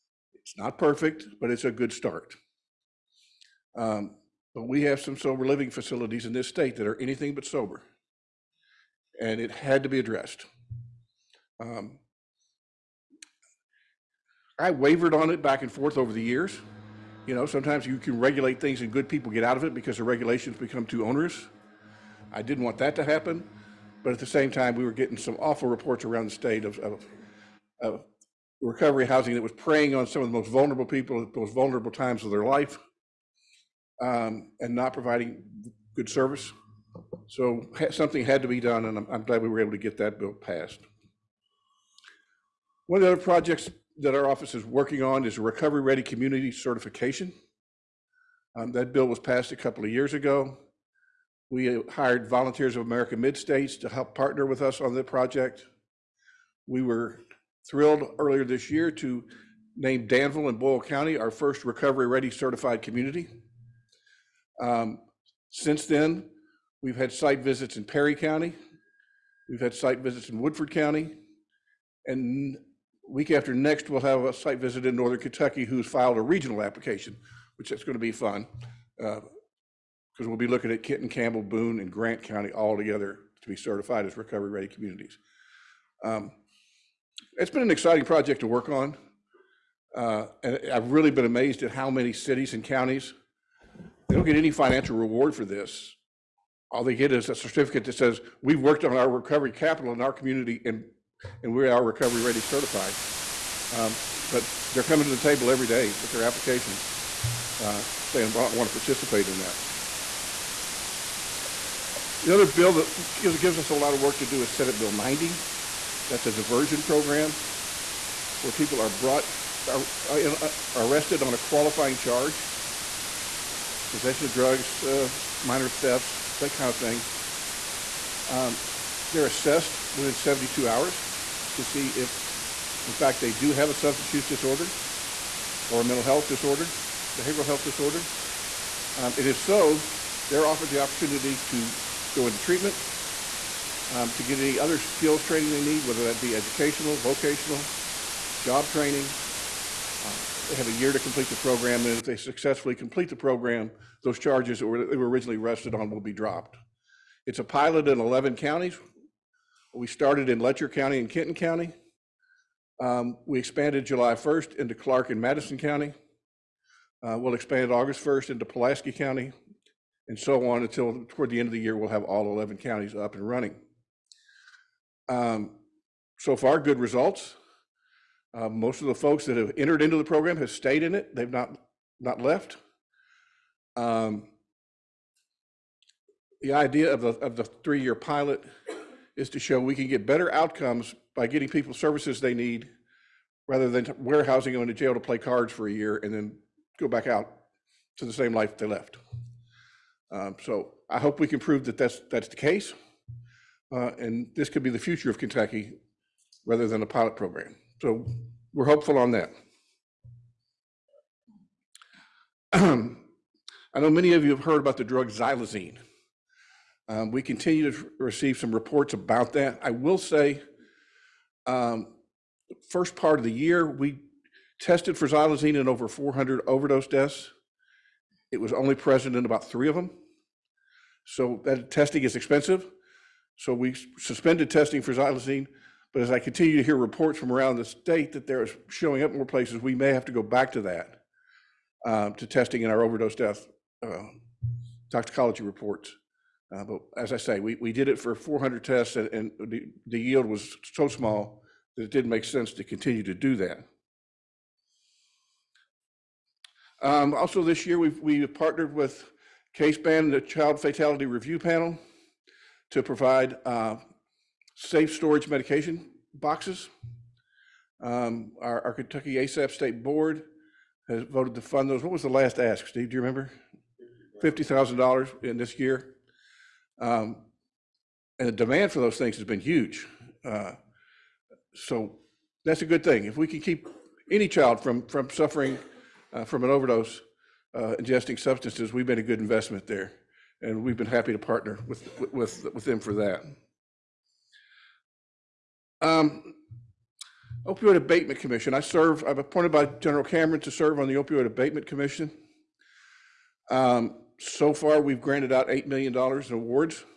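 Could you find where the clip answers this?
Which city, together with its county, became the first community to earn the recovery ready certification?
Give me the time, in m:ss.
1:00.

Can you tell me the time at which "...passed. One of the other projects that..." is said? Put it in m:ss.
0:40.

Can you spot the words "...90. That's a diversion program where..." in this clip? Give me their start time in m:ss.
1:54.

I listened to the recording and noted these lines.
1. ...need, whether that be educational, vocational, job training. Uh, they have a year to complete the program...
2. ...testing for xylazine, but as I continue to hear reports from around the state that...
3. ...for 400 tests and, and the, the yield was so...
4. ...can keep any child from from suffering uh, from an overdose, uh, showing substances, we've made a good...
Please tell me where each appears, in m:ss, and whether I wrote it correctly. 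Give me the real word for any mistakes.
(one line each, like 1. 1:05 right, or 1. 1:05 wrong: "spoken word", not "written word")
1. 2:25 right
2. 3:54 right
3. 4:07 right
4. 4:43 wrong: "ingesting", not "showing".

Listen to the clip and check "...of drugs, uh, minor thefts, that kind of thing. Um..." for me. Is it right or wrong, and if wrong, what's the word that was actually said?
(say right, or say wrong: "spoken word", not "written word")
right.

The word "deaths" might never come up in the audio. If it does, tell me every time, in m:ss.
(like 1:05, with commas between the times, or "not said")
3:46, 4:03.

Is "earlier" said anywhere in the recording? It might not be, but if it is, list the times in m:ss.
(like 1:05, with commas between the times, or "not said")
0:58.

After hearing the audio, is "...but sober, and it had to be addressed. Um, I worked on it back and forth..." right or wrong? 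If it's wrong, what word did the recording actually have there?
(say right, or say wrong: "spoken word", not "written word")
wrong: "wavered", not "worked".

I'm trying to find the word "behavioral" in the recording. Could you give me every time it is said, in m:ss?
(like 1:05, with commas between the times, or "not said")
2:17.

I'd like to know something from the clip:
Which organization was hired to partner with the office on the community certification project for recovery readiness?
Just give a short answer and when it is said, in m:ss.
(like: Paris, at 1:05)
Volunteers of America Mid States, at 0:52.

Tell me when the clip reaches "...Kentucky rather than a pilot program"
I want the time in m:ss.
3:25.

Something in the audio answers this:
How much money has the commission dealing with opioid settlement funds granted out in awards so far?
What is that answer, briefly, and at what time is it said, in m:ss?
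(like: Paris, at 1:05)
$8 million, at 5:05.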